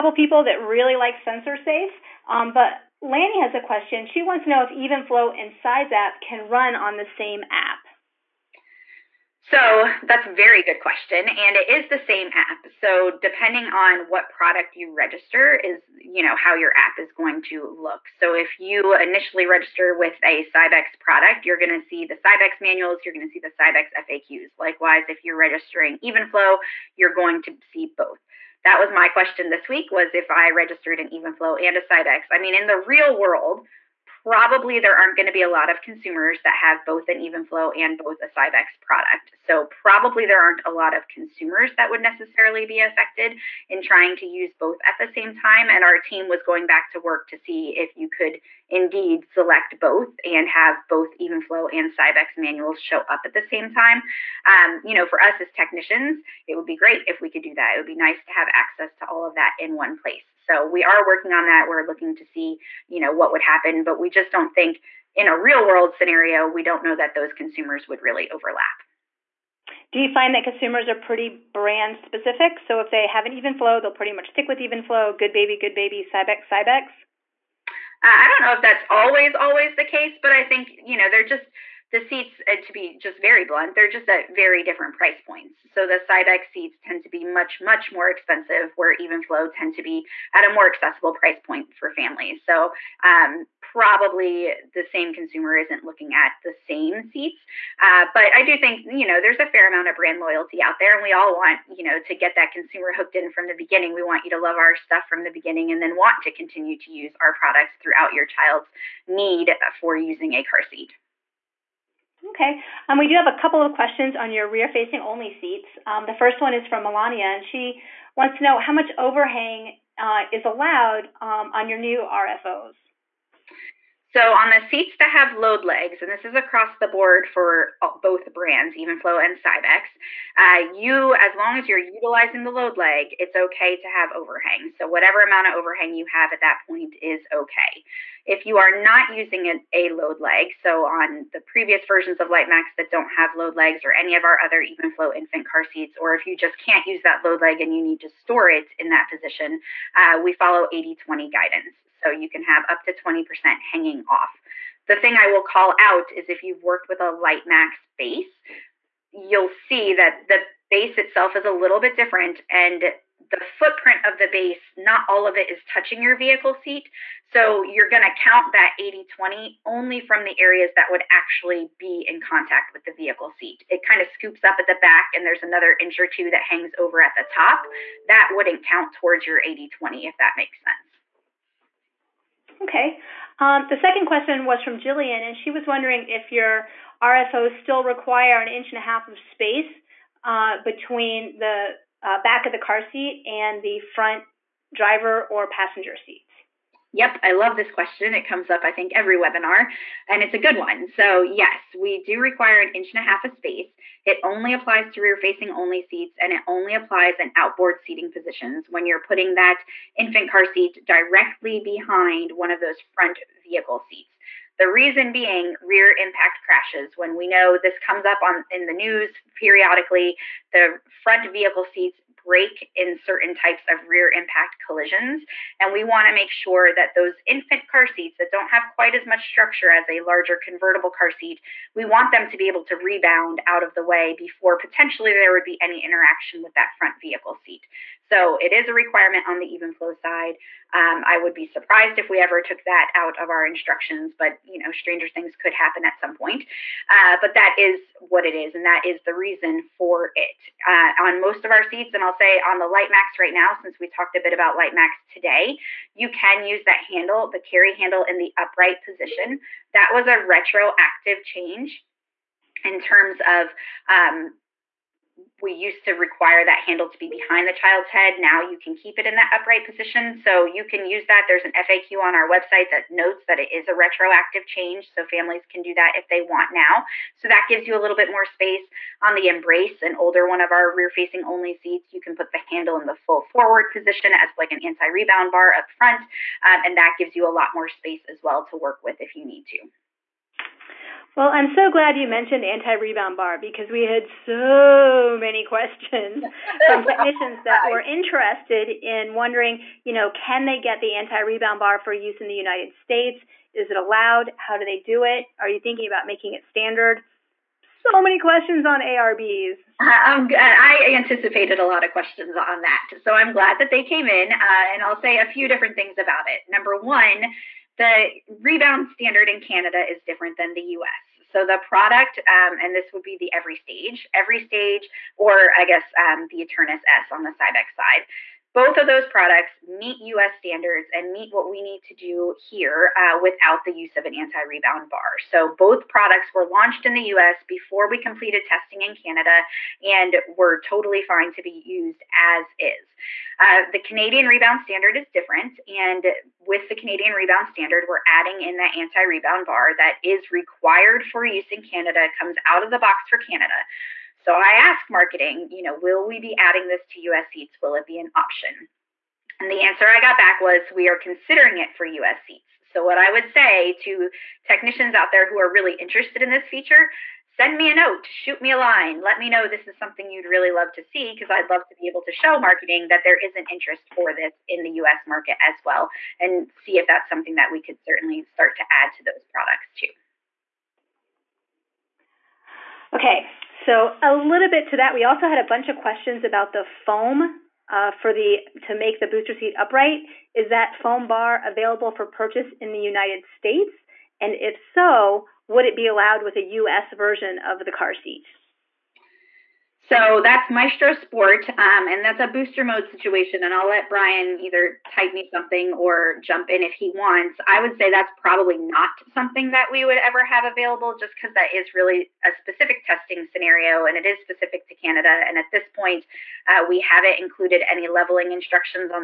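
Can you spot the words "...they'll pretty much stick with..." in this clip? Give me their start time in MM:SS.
01:13.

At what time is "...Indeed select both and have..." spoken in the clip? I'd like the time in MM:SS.
00:48.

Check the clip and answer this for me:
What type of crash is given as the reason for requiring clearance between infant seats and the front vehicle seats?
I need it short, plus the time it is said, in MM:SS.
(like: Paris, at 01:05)
rear impact crashes, at 03:35.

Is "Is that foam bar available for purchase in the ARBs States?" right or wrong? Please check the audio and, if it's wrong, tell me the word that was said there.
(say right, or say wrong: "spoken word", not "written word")
wrong: "United", not "ARBs".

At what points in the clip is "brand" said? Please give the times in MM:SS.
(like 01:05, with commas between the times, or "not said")
01:11, 01:39, 02:08.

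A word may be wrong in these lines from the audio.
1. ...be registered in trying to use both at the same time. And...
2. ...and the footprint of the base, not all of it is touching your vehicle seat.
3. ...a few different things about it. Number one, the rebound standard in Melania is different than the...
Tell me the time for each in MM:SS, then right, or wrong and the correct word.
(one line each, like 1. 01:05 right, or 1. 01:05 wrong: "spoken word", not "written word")
1. 00:42 wrong: "affected", not "registered"
2. 02:42 right
3. 05:15 wrong: "Canada", not "Melania".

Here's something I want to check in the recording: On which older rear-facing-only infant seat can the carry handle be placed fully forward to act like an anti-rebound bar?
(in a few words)
Embrace.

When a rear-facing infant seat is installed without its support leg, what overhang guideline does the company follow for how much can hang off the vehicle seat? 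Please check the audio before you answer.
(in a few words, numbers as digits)
80-20.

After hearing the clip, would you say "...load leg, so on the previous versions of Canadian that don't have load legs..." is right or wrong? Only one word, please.
wrong.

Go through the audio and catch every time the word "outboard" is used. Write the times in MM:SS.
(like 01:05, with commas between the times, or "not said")
03:27.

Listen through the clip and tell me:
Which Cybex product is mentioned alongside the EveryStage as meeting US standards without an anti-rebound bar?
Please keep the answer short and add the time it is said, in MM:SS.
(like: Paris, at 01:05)
Eternis S, at 05:26.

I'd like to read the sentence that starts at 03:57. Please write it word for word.
So it is a requirement on the Evenflo side.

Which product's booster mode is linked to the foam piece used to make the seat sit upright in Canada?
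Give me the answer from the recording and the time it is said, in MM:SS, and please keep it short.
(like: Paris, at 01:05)
Maestro Sport, at 06:40.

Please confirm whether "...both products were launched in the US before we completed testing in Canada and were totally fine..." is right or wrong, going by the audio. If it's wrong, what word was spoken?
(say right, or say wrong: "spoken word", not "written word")
right.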